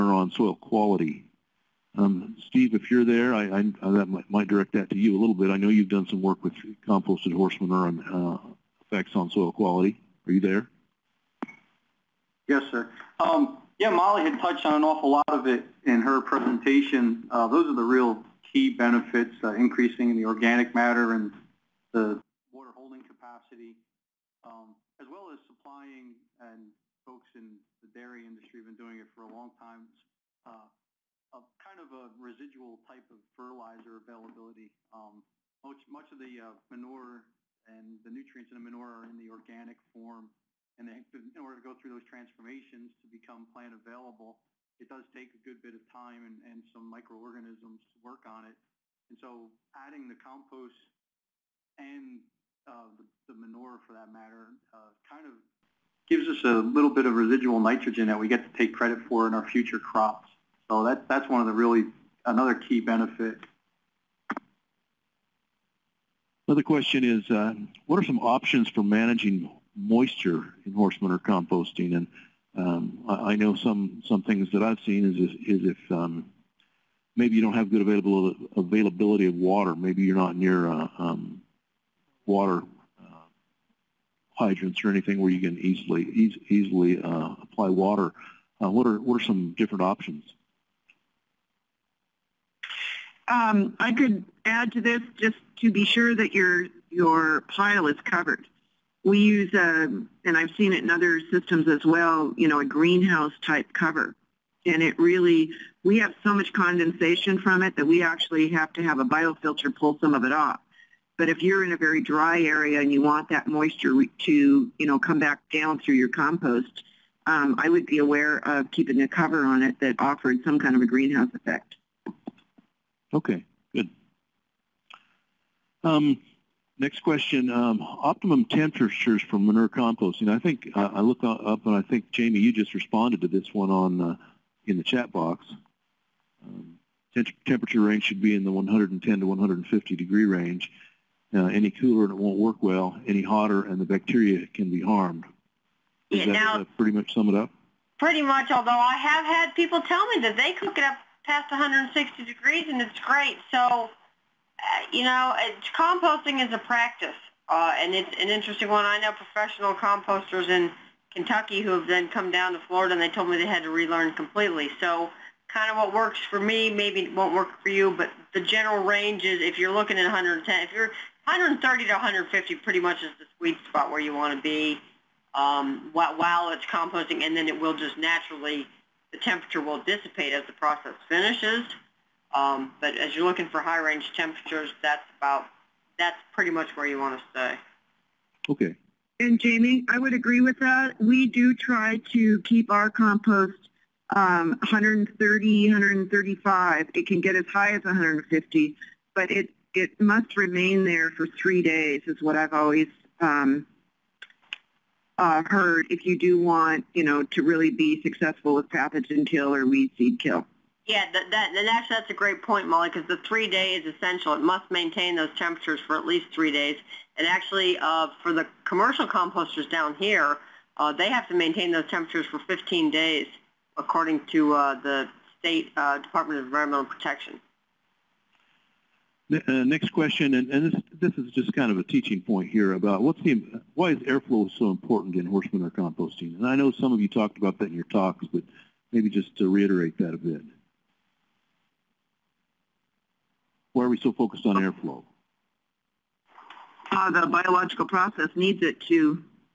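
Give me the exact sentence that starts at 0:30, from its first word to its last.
uh, a kind of a residual type of fertilizer availability.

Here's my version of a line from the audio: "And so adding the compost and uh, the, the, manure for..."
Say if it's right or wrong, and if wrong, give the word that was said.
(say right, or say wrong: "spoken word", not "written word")
right.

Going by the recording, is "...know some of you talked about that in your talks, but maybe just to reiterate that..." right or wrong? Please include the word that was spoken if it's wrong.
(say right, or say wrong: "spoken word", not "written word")
right.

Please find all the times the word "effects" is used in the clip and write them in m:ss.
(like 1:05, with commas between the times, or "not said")
0:08, 2:01.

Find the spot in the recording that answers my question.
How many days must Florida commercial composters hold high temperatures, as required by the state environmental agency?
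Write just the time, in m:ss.
3:42.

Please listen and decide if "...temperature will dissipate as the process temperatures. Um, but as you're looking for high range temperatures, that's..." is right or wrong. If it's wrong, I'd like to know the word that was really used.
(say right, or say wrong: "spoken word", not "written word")
wrong: "finishes", not "temperatures".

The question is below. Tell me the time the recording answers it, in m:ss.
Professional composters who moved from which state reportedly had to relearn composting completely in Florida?
2:41.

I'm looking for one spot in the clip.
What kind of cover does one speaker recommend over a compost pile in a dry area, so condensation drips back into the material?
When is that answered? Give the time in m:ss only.
1:42.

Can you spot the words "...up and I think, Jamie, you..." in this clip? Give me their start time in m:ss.
2:11.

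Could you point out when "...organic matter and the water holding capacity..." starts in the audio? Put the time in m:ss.
0:20.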